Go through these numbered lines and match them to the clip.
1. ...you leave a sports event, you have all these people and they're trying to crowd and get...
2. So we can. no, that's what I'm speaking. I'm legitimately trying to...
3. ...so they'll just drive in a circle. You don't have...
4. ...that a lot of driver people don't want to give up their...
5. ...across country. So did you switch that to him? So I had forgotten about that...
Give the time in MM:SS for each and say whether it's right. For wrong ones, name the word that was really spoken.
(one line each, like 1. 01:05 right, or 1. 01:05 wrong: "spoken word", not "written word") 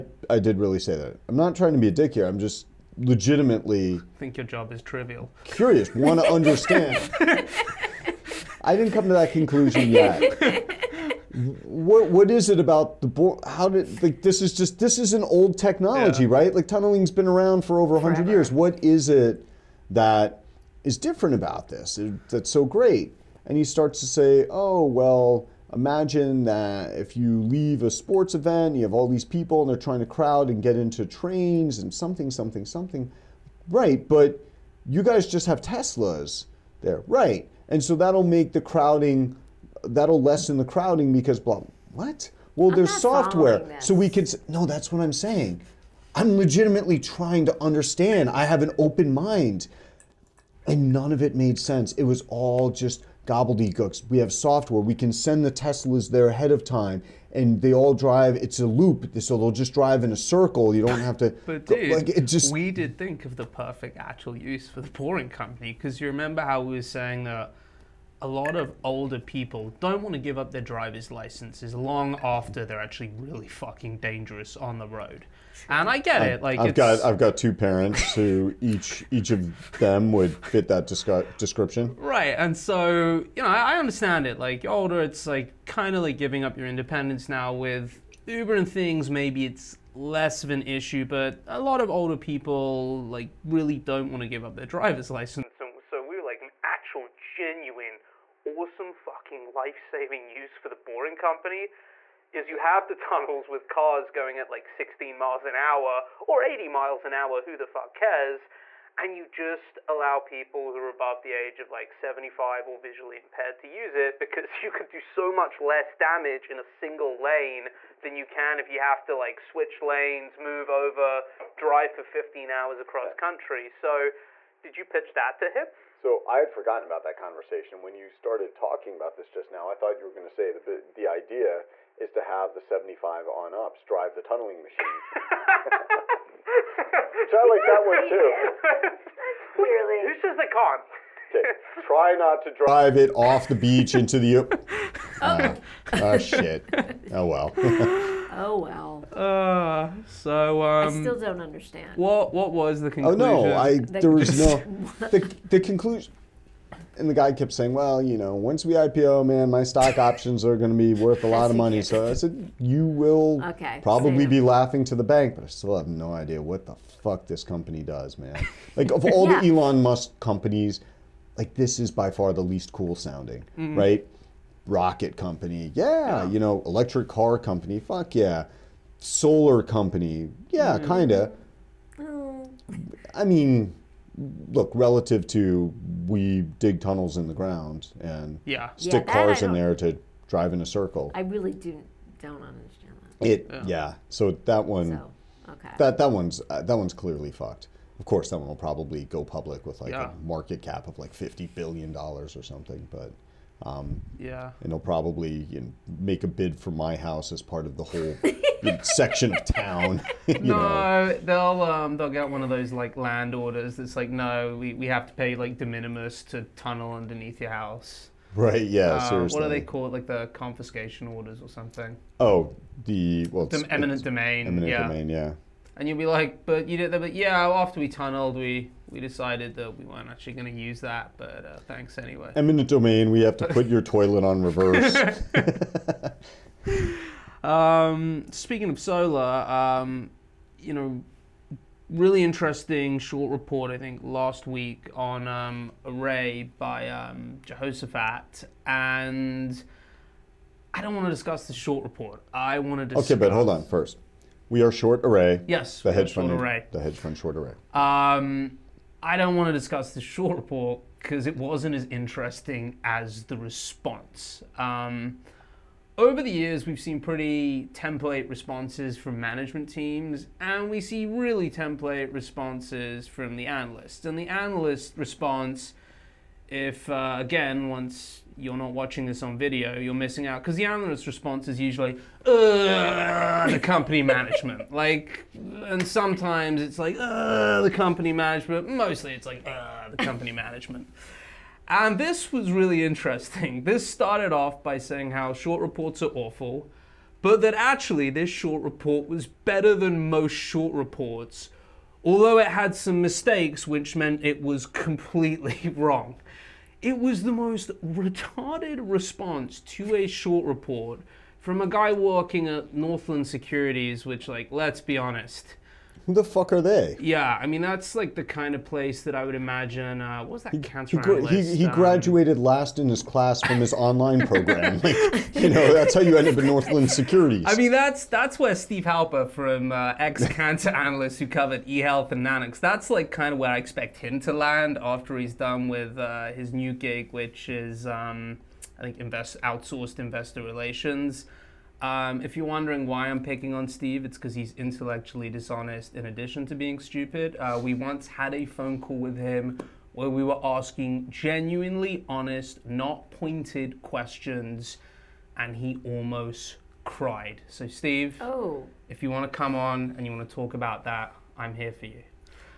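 1. 00:27 right
2. 00:43 wrong: "saying", not "speaking"
3. 00:59 right
4. 01:07 wrong: "older", not "driver"
5. 02:02 wrong: "pitch", not "switch".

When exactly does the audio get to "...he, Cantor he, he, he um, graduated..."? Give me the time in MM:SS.
05:20.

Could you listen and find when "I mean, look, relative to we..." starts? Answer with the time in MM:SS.
03:03.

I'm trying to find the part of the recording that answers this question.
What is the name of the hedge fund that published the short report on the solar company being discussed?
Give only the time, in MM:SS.
04:07.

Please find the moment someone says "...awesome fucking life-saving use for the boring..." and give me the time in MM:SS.
01:38.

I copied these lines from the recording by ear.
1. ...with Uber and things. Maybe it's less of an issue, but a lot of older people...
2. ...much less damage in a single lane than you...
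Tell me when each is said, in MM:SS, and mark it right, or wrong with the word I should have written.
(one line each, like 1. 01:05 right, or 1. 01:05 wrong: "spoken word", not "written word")
1. 01:27 right
2. 01:55 right.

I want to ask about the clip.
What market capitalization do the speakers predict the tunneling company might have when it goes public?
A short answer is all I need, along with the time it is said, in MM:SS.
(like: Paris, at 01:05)
$50 billion, at 03:21.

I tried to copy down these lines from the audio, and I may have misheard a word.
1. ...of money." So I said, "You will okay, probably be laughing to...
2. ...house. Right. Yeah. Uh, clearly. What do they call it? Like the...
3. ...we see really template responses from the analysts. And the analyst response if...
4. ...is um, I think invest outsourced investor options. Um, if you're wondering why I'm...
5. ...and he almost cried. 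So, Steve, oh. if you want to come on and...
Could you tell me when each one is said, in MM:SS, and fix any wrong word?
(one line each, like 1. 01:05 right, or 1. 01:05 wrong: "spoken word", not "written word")
1. 02:41 right
2. 03:37 wrong: "seriously", not "clearly"
3. 04:30 right
4. 05:37 wrong: "relations", not "options"
5. 05:55 right.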